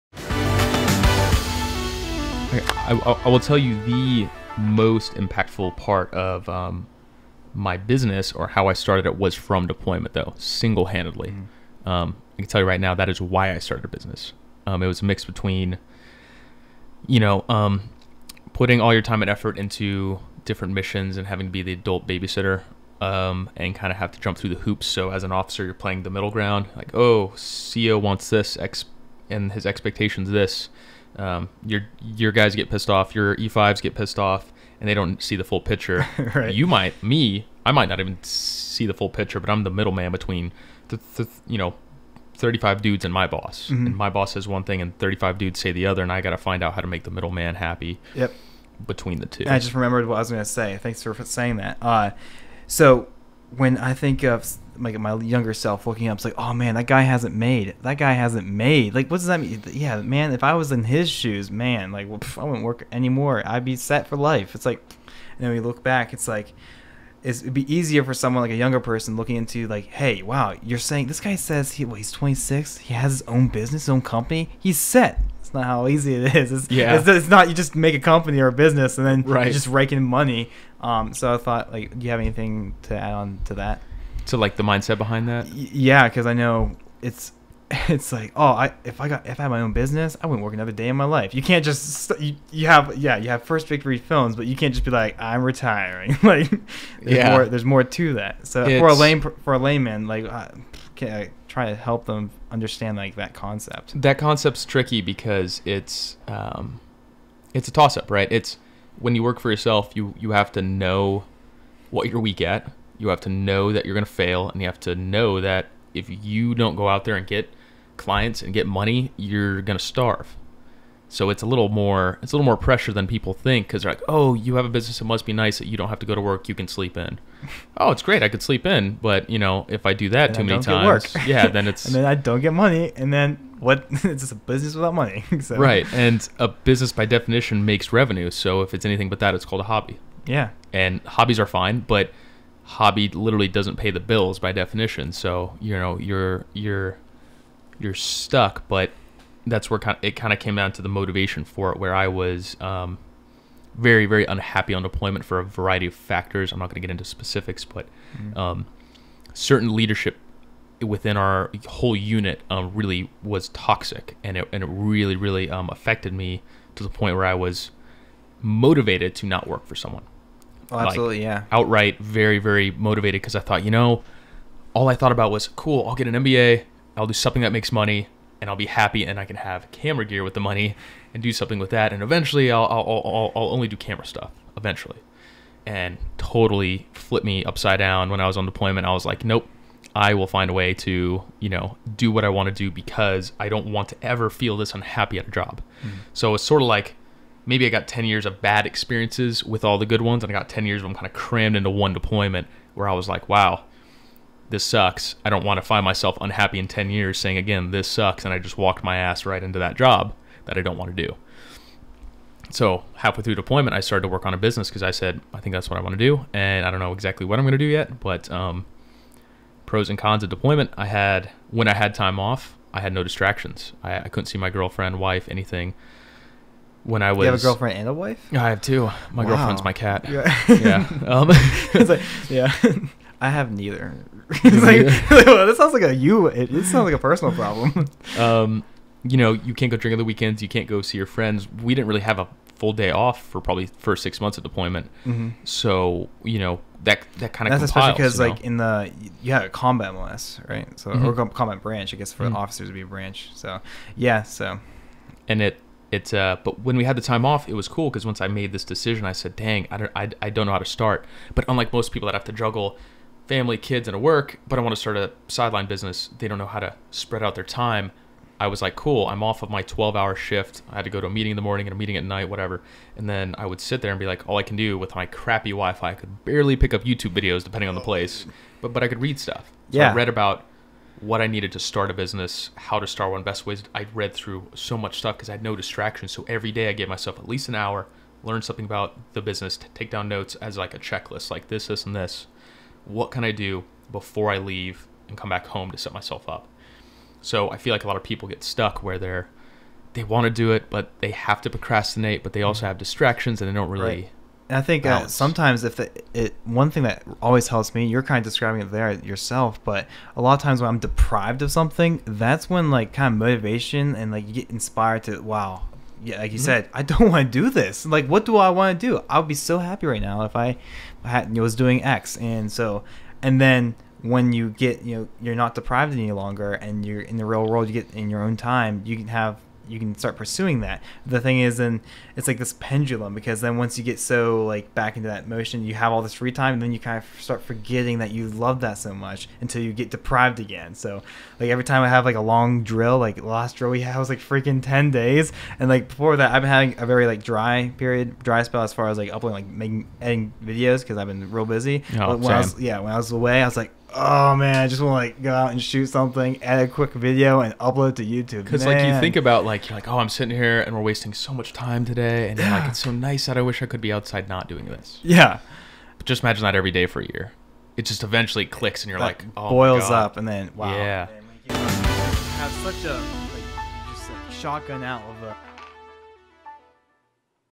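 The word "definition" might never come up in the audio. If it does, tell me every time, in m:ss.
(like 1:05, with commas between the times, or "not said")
2:17, 2:24.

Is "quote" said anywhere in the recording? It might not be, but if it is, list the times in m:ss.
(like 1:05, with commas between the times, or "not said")
not said.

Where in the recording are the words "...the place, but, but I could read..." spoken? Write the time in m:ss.
4:37.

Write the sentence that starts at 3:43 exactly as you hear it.
I, I couldn't see my girlfriend, wife, anything.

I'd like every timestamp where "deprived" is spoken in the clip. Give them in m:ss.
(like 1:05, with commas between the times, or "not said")
5:10, 5:25, 5:39.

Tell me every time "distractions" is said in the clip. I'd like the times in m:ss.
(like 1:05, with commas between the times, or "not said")
3:43, 4:45, 5:02.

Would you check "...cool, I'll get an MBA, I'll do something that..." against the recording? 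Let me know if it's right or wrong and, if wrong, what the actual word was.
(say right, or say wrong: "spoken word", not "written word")
right.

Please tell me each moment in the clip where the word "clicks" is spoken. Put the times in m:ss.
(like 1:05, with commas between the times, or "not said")
6:08.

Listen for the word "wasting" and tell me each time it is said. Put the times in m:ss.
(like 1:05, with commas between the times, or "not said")
6:00.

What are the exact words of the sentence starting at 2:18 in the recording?
So if it's anything but that, it's called a hobby.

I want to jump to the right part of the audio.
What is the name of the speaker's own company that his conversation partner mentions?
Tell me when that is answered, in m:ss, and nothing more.
1:33.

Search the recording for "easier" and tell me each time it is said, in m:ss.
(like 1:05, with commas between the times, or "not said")
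1:07.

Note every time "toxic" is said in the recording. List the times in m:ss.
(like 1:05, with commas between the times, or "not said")
2:43.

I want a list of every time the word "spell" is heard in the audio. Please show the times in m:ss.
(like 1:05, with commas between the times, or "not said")
5:48.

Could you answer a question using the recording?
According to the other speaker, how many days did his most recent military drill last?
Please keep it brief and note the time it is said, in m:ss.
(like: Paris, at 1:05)
10 days, at 5:44.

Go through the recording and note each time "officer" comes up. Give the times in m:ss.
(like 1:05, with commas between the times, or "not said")
0:25, 4:12.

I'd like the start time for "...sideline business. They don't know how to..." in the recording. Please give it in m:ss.
4:25.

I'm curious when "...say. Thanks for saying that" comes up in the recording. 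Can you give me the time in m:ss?
0:50.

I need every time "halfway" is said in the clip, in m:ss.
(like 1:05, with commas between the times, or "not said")
3:32.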